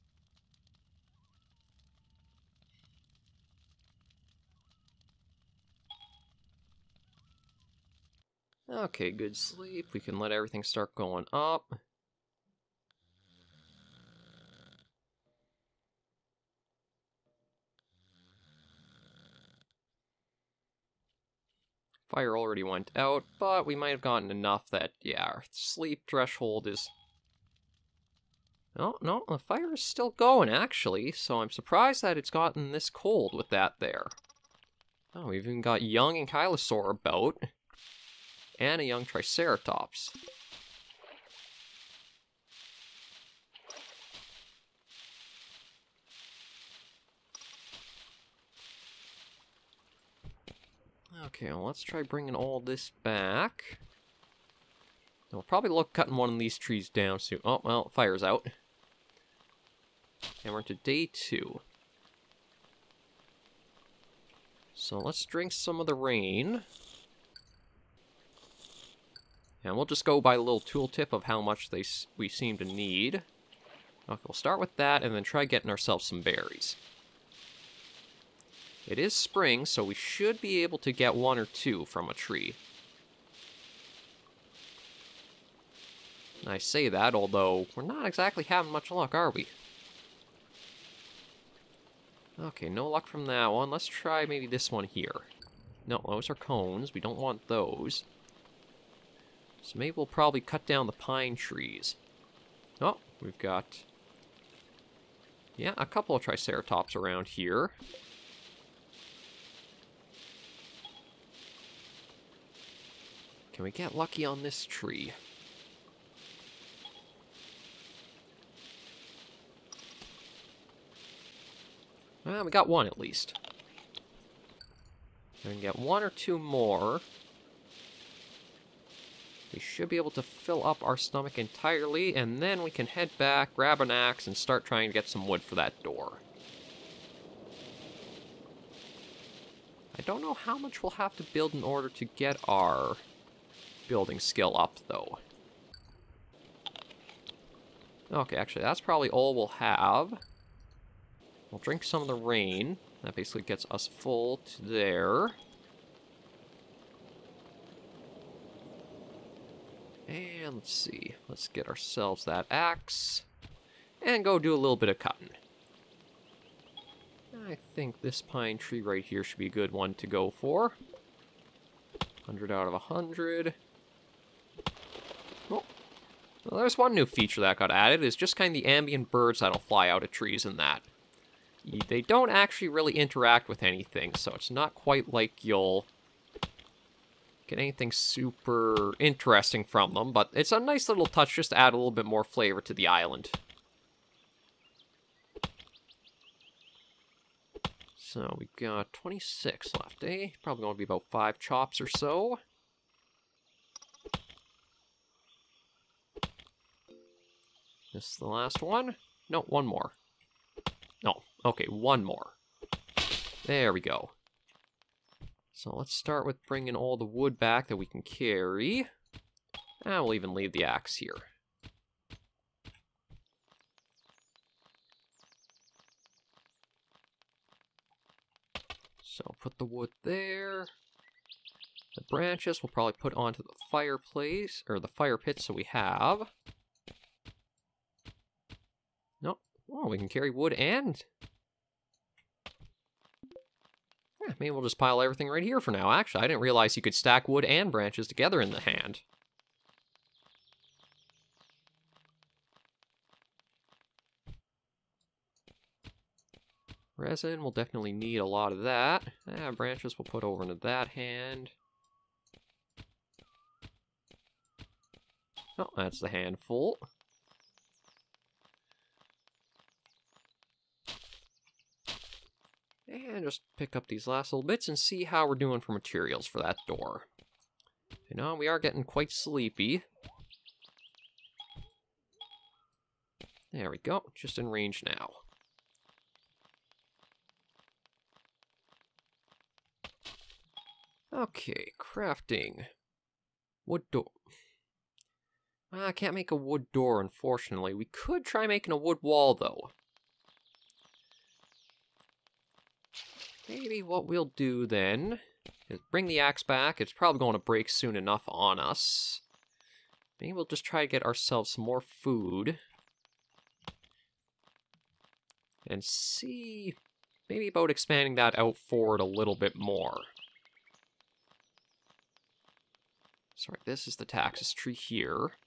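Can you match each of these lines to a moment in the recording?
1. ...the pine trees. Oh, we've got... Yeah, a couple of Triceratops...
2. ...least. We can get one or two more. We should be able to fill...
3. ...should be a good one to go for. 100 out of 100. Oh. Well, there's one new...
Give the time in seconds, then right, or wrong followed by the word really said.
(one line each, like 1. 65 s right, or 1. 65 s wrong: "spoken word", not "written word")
1. 100 s right
2. 122 s right
3. 169 s right.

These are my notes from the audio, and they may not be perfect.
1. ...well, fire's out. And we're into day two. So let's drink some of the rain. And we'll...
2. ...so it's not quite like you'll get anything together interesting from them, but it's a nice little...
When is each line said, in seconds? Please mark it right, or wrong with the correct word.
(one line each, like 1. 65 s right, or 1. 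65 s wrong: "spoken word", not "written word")
1. 57 s right
2. 184 s wrong: "super", not "together".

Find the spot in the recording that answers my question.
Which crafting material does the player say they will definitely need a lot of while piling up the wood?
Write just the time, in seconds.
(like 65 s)
256 s.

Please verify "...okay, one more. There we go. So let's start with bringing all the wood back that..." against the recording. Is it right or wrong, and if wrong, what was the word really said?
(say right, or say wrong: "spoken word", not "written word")
right.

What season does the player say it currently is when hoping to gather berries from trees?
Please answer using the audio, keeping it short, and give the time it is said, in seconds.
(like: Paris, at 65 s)
Spring, at 79 s.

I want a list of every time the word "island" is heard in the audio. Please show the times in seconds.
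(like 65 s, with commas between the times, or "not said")
192 s.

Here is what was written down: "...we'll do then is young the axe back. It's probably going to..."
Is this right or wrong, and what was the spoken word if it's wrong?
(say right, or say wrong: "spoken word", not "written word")
wrong: "bring", not "young".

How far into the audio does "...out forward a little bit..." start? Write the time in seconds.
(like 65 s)
318 s.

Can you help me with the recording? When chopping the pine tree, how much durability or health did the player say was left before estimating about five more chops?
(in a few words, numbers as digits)
26.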